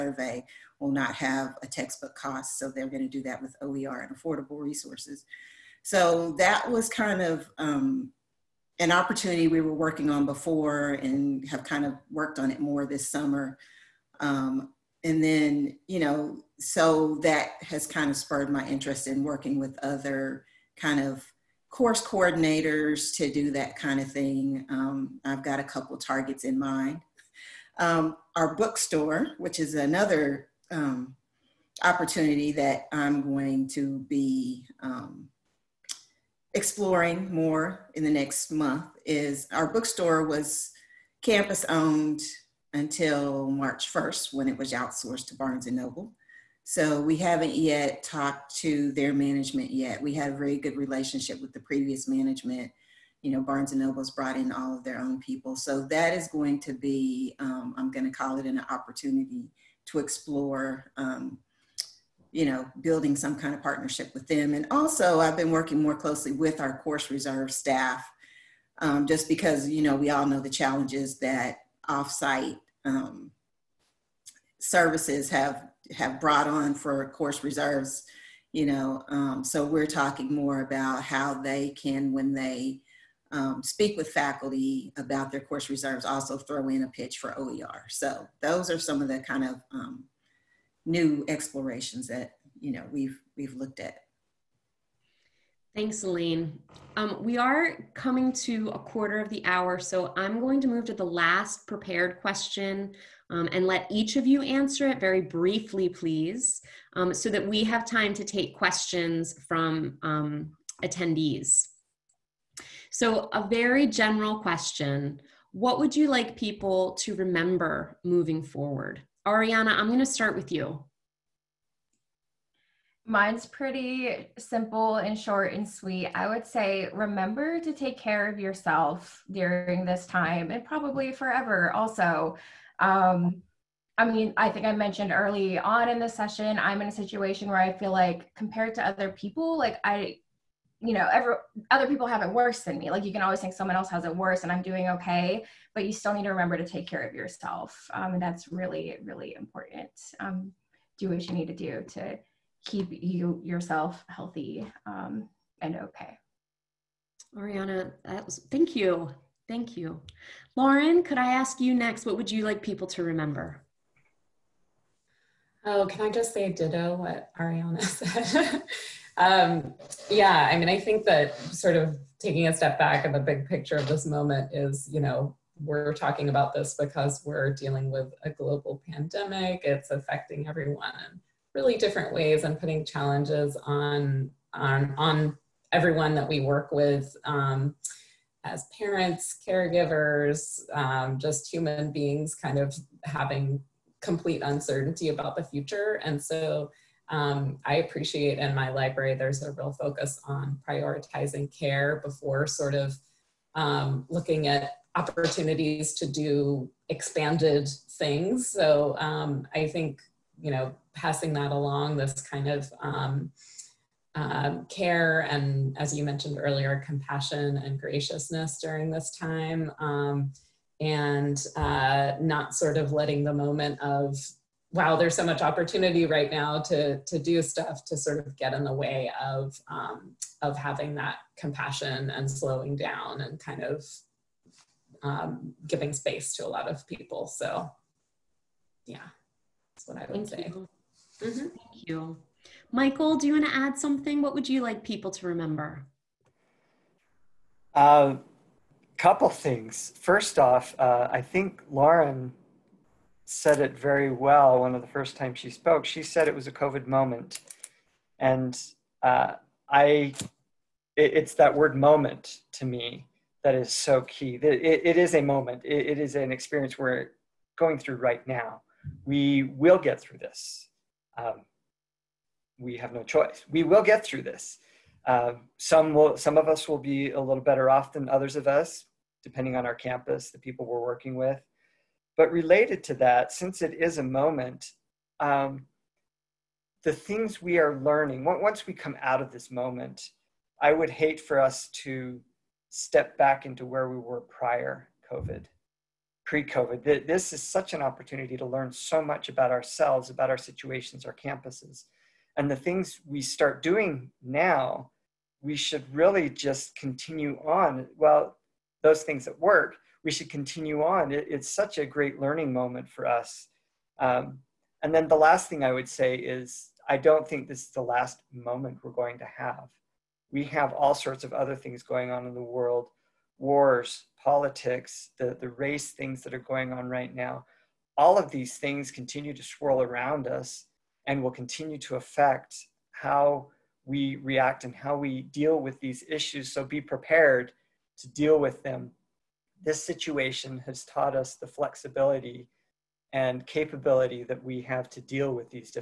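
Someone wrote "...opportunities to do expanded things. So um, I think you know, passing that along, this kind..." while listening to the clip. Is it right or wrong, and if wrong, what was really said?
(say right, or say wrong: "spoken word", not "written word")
right.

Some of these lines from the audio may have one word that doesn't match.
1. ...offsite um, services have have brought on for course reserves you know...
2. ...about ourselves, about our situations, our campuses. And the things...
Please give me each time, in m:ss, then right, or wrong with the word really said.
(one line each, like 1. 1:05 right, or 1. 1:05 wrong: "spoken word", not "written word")
1. 1:11 right
2. 4:59 right.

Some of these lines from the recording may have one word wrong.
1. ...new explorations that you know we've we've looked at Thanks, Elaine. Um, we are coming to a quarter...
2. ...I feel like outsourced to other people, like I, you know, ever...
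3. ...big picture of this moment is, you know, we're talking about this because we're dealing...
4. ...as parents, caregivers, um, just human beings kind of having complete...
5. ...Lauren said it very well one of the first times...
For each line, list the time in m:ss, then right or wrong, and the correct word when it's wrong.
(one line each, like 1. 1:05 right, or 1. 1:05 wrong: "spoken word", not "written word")
1. 1:30 right
2. 2:17 wrong: "compared", not "outsourced"
3. 2:53 right
4. 3:08 right
5. 4:11 right.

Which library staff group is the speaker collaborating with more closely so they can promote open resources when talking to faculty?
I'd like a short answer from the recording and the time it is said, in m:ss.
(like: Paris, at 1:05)
course reserve staff, at 1:06.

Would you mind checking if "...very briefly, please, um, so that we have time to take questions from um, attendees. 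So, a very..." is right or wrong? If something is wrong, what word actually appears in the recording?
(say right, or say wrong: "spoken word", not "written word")
right.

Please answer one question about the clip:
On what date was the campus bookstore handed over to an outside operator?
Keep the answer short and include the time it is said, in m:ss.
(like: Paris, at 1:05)
March 1st, at 0:43.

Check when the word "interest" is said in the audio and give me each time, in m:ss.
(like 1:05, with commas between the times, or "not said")
0:18.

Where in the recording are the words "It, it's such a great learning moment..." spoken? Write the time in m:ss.
5:11.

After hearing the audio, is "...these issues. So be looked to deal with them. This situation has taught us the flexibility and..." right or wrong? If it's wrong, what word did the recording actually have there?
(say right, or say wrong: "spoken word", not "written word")
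wrong: "prepared", not "looked".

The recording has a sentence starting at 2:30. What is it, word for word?
Um, do what you need to do to keep you yourself healthy um, and okay.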